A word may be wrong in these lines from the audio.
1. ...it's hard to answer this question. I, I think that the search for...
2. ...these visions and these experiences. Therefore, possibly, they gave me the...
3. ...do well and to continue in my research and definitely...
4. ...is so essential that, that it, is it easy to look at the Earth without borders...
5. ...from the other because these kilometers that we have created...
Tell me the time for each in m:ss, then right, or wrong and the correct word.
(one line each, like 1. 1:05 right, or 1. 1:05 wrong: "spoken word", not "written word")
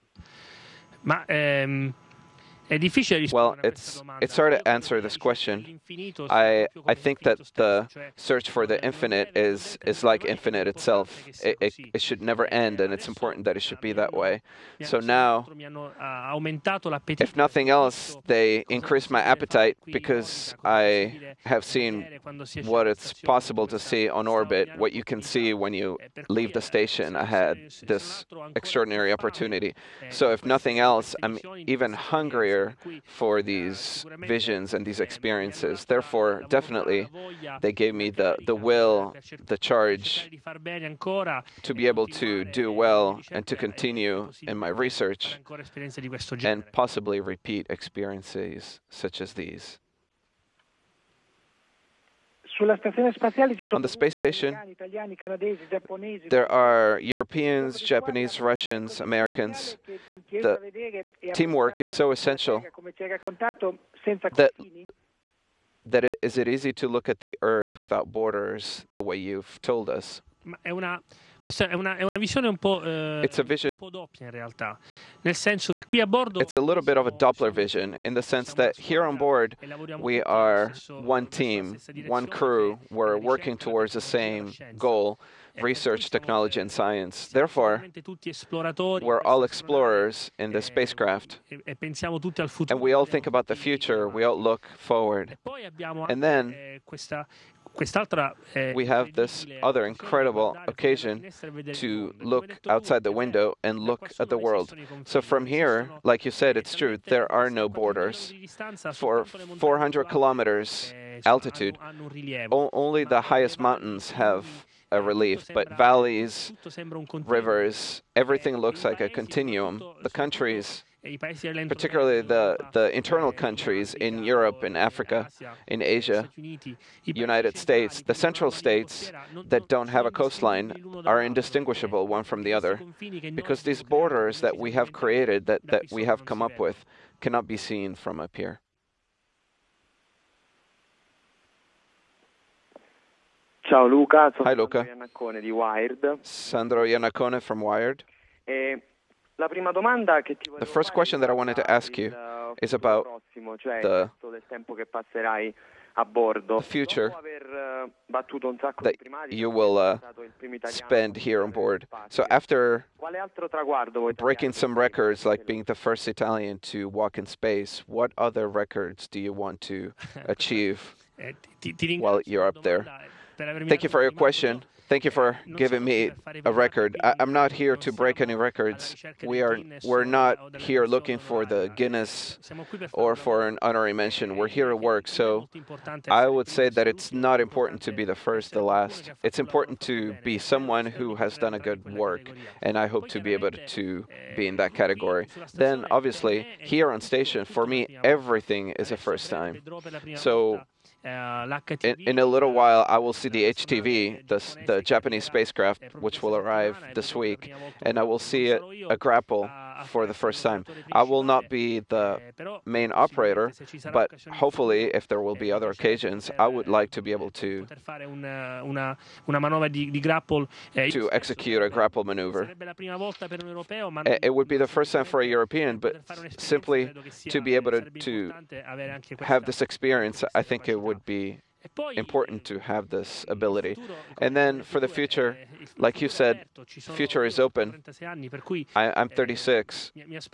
1. 0:04 right
2. 0:33 wrong: "definitely", not "possibly"
3. 0:42 wrong: "possibly", not "definitely"
4. 1:01 right
5. 2:12 wrong: "borders", not "kilometers".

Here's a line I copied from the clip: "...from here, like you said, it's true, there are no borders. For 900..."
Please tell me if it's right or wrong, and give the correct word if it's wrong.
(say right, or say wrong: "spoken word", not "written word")
wrong: "400", not "900".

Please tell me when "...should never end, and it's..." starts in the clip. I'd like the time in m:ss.
0:12.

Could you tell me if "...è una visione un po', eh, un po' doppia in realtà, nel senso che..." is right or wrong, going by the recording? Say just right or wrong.
right.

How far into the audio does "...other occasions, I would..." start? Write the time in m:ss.
3:35.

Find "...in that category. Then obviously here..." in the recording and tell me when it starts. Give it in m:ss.
3:14.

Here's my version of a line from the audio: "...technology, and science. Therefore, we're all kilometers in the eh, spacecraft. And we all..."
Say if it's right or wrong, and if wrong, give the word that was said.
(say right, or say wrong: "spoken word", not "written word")
wrong: "explorers", not "kilometers".